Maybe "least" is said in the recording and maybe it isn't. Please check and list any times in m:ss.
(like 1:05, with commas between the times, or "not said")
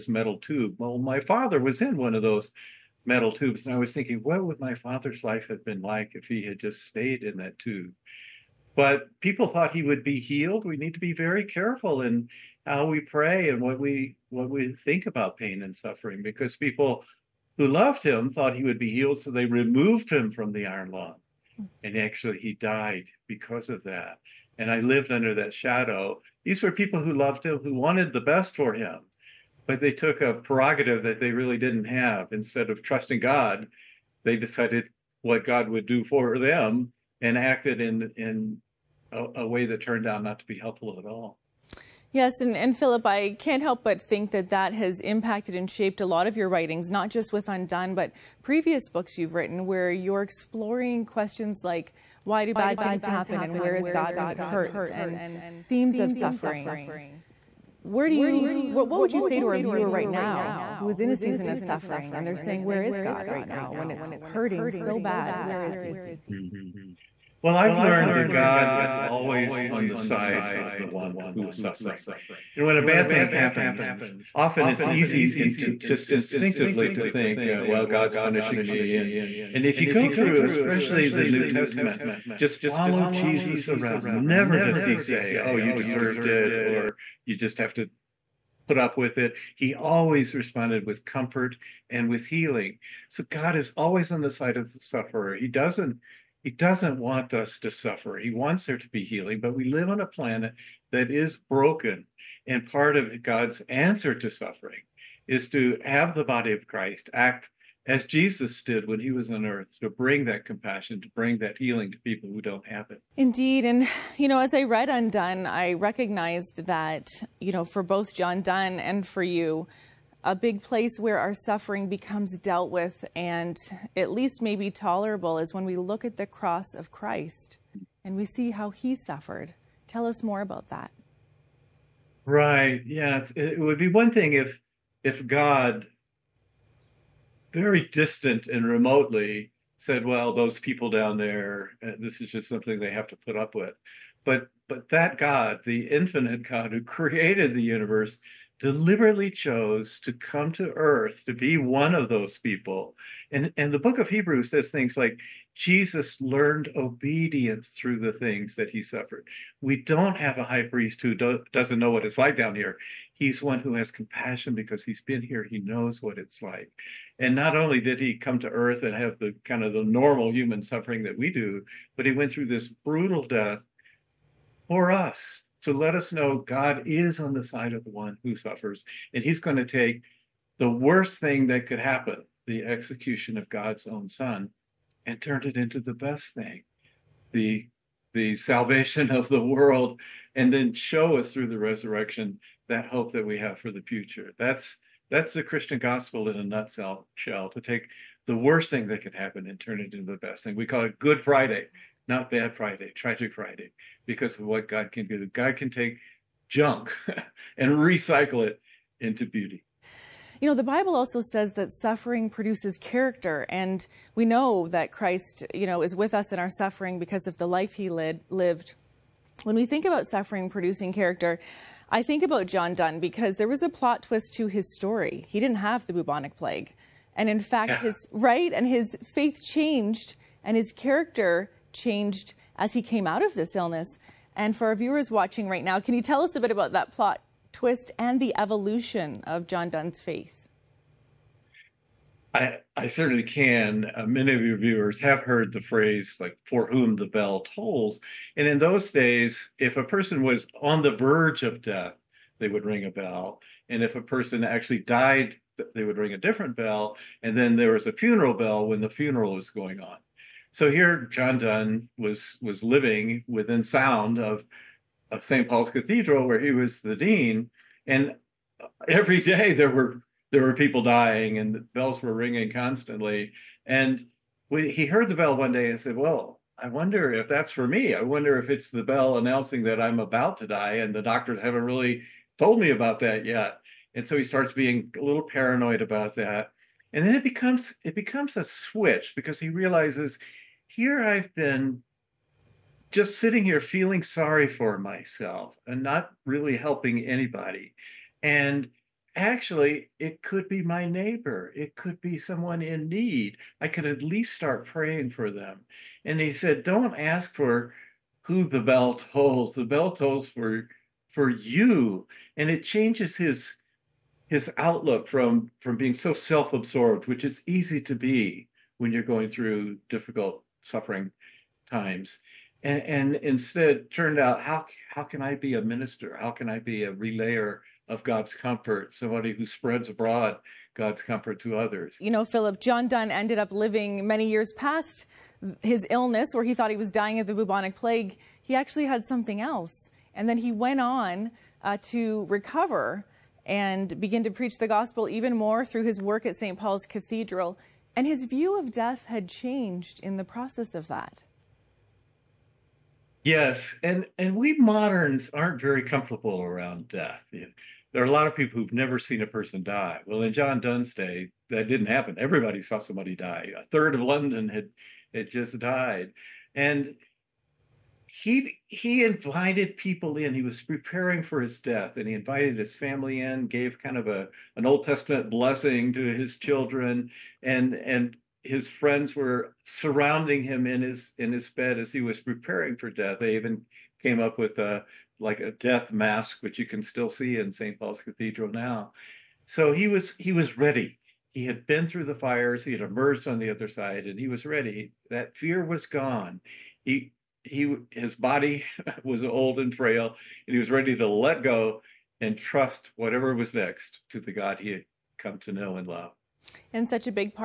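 2:04, 5:04.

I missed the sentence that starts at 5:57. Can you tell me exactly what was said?
There are a lot of people who've never seen a person die.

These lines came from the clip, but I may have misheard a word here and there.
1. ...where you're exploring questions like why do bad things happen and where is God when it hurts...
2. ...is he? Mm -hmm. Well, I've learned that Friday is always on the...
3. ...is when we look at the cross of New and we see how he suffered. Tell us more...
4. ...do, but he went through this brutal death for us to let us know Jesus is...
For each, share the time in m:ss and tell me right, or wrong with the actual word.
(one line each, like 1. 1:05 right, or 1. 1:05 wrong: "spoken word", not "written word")
1. 0:49 right
2. 1:05 wrong: "God", not "Friday"
3. 2:05 wrong: "Christ", not "New"
4. 2:51 wrong: "God", not "Jesus".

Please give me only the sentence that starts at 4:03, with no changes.
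Uh, many of your viewers have heard the phrase, like, for whom the bell tolls.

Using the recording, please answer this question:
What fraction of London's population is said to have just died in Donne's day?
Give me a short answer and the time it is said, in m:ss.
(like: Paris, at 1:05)
A third, at 6:03.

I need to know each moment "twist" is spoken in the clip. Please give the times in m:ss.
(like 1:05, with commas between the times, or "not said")
3:44, 3:57.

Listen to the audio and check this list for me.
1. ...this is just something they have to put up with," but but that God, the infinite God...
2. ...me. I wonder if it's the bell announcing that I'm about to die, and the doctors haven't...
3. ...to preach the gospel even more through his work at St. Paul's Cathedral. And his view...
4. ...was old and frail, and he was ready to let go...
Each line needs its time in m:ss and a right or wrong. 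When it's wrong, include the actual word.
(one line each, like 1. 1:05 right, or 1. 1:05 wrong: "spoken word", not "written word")
1. 2:21 right
2. 4:37 right
3. 5:44 right
4. 6:39 right.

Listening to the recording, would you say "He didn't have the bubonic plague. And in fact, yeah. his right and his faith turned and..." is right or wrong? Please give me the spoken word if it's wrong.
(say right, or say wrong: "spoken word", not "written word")
wrong: "changed", not "turned".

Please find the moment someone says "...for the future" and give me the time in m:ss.
3:13.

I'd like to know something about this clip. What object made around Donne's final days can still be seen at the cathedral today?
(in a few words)
Death mask.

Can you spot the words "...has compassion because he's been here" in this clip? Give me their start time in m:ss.
2:43.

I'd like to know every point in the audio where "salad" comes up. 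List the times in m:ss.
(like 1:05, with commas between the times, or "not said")
not said.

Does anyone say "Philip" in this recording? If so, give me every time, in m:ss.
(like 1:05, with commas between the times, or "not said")
0:42, 5:32.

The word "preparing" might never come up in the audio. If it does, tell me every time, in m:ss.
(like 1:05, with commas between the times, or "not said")
6:10, 6:22.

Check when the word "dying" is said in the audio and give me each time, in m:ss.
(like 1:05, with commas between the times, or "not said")
4:30, 5:36.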